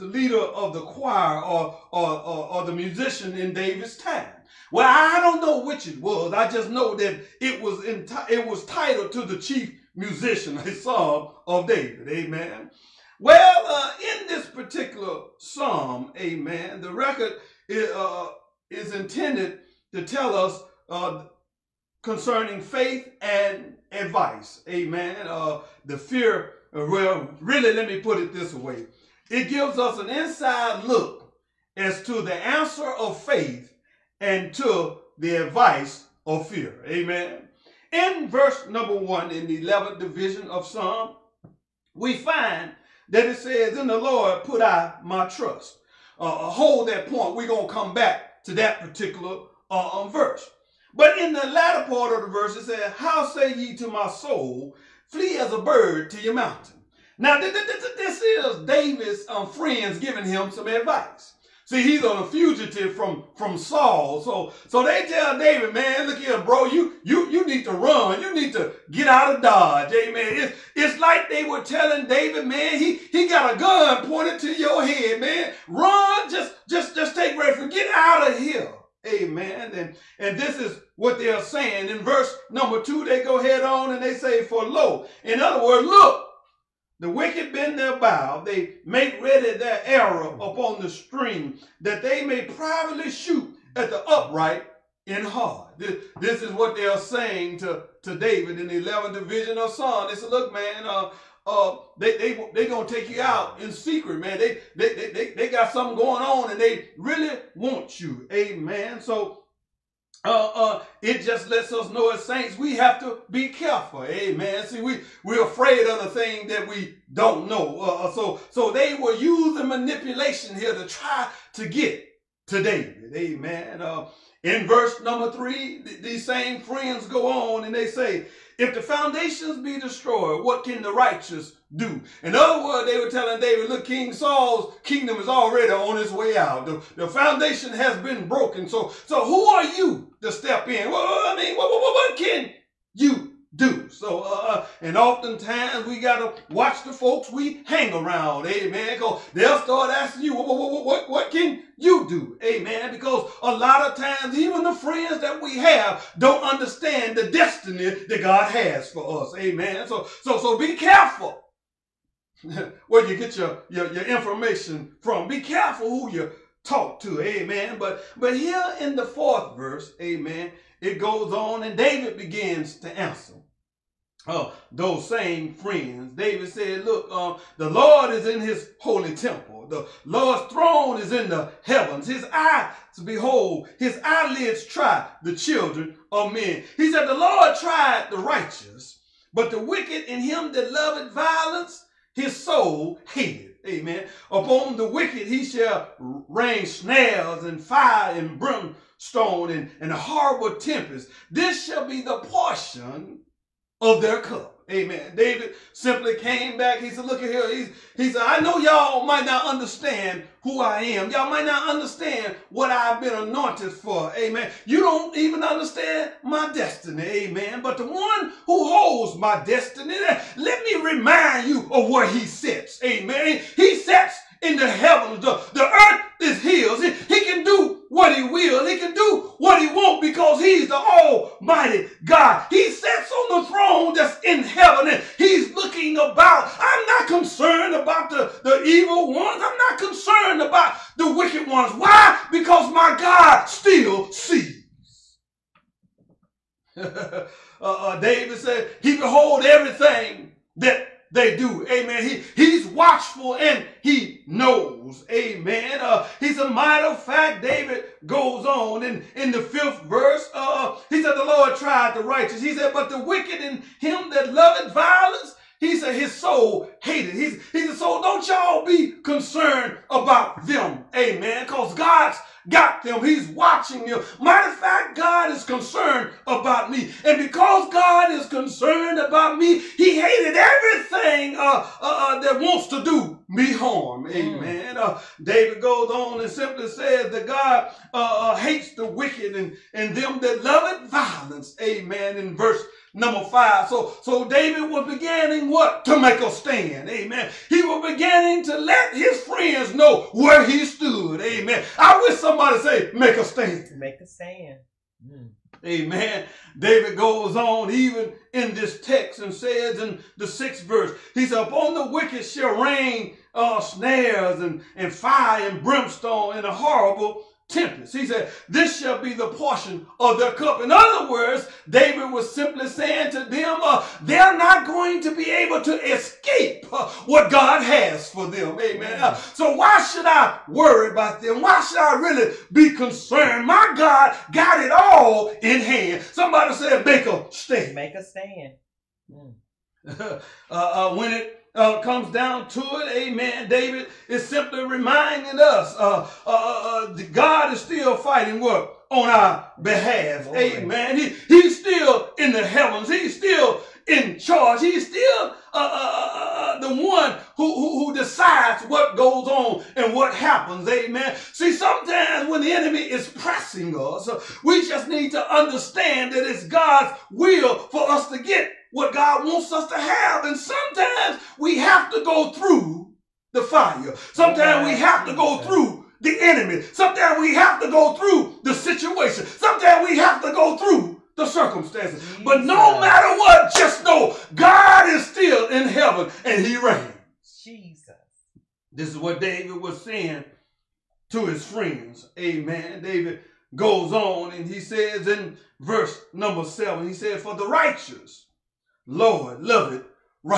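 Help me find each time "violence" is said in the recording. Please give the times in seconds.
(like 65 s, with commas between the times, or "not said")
191 s, 264 s, 290 s.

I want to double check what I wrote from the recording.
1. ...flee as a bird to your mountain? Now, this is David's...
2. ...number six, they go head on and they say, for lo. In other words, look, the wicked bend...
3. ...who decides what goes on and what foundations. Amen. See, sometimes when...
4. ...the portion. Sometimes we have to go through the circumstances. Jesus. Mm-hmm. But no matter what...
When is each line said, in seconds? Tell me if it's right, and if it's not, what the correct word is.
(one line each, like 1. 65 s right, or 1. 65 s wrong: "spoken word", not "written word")
1. 55 s right
2. 82 s wrong: "two", not "six"
3. 357 s wrong: "happens", not "foundations"
4. 378 s wrong: "situation", not "portion".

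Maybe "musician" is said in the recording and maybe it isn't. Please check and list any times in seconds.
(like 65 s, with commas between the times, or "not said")
2 s, 9 s.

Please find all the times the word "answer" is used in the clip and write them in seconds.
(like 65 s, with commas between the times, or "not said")
32 s, 172 s.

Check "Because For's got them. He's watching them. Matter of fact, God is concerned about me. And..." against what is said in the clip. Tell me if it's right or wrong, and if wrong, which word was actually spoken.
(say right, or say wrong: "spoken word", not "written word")
wrong: "God", not "For".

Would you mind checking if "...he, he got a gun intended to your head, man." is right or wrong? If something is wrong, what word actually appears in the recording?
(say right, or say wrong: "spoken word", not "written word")
wrong: "pointed", not "intended".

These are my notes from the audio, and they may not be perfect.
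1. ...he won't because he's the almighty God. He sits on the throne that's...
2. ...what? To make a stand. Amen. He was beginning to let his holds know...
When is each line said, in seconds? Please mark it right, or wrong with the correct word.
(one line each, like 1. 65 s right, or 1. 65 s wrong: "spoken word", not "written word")
1. 229 s right
2. 295 s wrong: "friends", not "holds".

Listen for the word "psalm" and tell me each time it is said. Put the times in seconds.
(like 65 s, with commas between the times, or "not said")
10 s, 15 s, 40 s, 99 s.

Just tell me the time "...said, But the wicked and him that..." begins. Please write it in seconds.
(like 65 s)
262 s.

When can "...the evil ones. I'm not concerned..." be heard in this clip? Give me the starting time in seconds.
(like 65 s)
238 s.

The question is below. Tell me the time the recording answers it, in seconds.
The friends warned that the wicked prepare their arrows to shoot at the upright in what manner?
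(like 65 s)
92 s.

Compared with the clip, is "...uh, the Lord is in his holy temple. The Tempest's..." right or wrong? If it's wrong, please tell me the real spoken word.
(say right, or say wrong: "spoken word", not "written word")
wrong: "Lord", not "Tempest".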